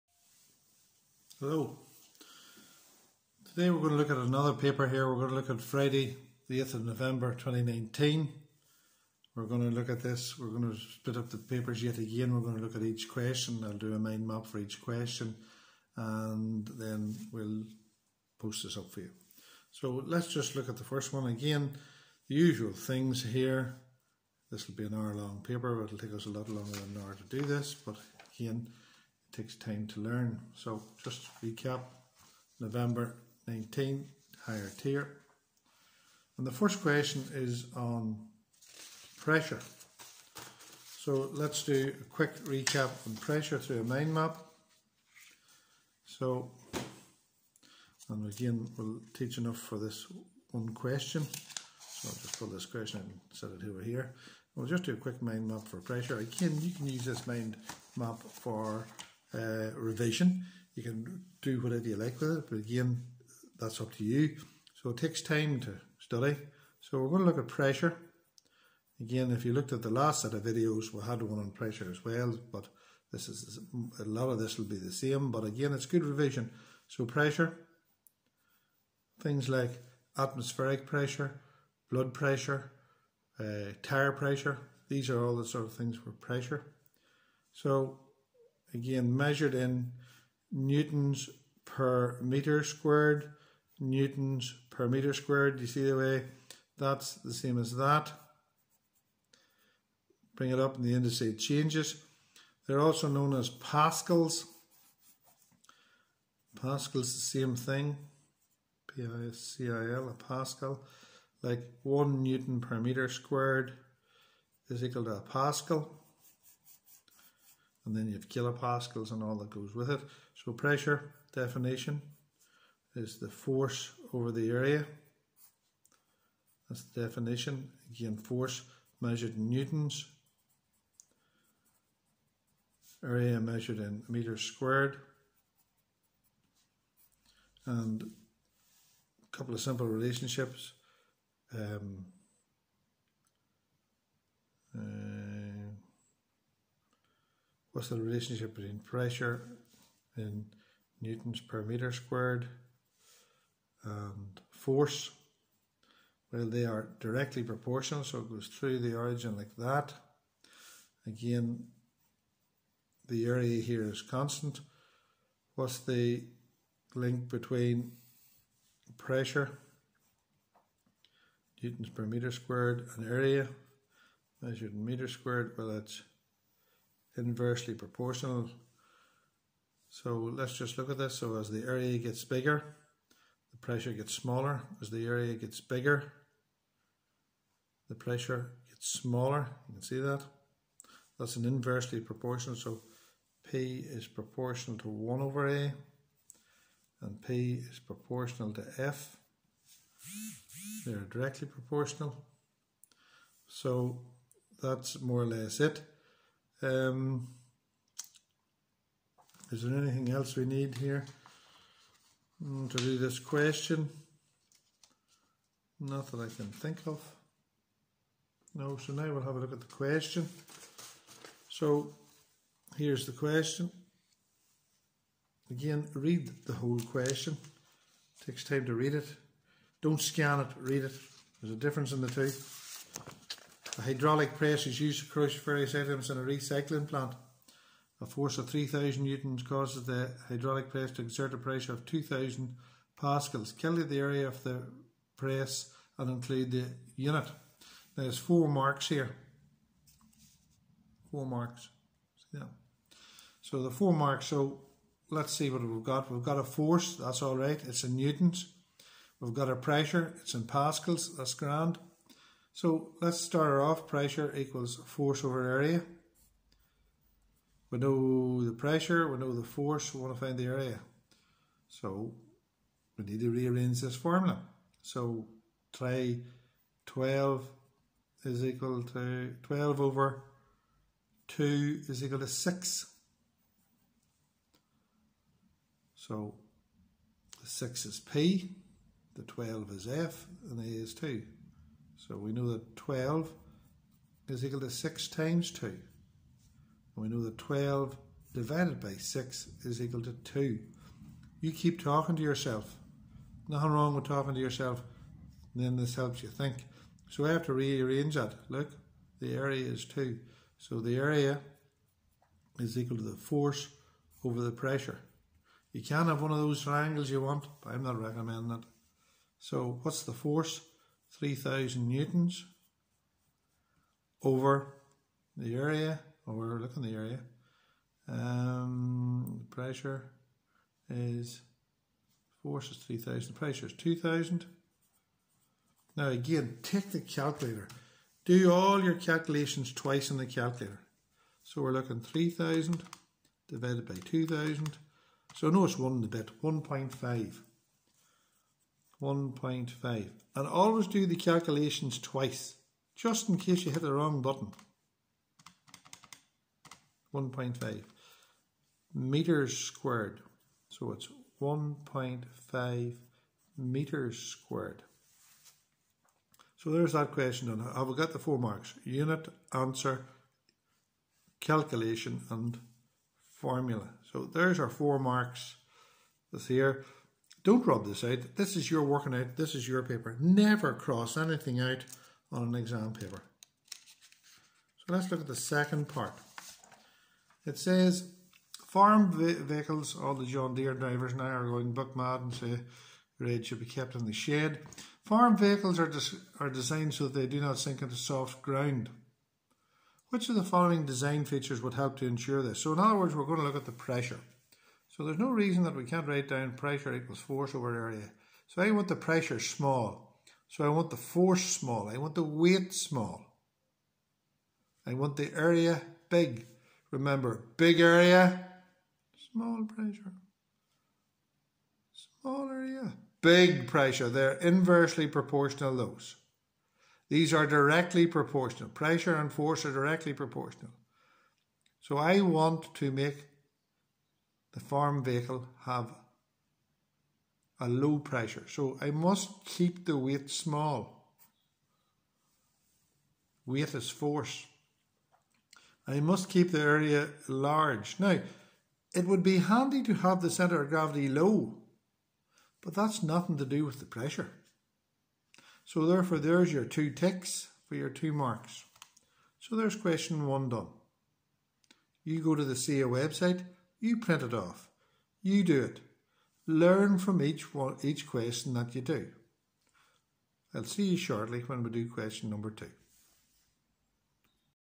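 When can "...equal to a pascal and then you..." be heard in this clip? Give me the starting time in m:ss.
1:54.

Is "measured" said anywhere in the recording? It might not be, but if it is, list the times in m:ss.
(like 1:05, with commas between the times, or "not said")
1:29, 2:09, 2:13, 2:54.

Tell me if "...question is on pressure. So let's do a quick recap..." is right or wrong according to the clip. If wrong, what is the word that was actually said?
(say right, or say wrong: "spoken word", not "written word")
right.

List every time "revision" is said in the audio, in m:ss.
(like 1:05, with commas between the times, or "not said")
0:59, 1:16.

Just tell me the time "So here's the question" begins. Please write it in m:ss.
3:41.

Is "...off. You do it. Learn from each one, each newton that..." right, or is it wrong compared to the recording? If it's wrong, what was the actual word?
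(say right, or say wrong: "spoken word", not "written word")
wrong: "question", not "newton".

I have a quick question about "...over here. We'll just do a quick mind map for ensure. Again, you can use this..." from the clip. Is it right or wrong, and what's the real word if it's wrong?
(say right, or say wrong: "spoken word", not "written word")
wrong: "pressure", not "ensure".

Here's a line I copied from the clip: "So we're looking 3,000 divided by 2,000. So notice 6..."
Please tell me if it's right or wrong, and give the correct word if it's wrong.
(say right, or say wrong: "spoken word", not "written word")
wrong: "1", not "6".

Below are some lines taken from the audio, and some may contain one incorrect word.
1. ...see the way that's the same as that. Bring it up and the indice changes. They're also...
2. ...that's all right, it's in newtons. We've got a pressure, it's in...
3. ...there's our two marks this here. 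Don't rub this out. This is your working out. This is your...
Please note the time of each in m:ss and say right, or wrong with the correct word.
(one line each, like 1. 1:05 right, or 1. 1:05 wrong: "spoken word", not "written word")
1. 1:35 right
2. 4:16 right
3. 6:14 wrong: "four", not "two".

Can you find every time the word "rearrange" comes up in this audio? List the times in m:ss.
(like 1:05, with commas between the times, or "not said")
4:33, 5:07.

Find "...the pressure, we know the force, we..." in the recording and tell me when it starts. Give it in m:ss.
4:28.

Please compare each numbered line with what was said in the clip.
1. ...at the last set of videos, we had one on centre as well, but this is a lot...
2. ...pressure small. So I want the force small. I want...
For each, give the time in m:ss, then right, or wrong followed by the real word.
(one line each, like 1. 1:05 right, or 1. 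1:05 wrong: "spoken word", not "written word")
1. 1:09 wrong: "pressure", not "centre"
2. 6:48 right.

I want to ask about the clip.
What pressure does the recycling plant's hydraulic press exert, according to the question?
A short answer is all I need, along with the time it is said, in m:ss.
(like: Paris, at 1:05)
2,000 pascals, at 4:01.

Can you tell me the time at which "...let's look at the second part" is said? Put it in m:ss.
6:24.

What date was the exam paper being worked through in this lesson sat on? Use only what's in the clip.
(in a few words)
Friday 8th of November 2019.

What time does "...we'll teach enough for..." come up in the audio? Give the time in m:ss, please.
0:48.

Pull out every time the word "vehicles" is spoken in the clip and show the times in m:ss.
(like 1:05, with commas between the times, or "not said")
6:29, 6:35, 7:15.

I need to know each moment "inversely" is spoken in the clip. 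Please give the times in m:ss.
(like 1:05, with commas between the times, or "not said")
2:57, 3:11, 7:04.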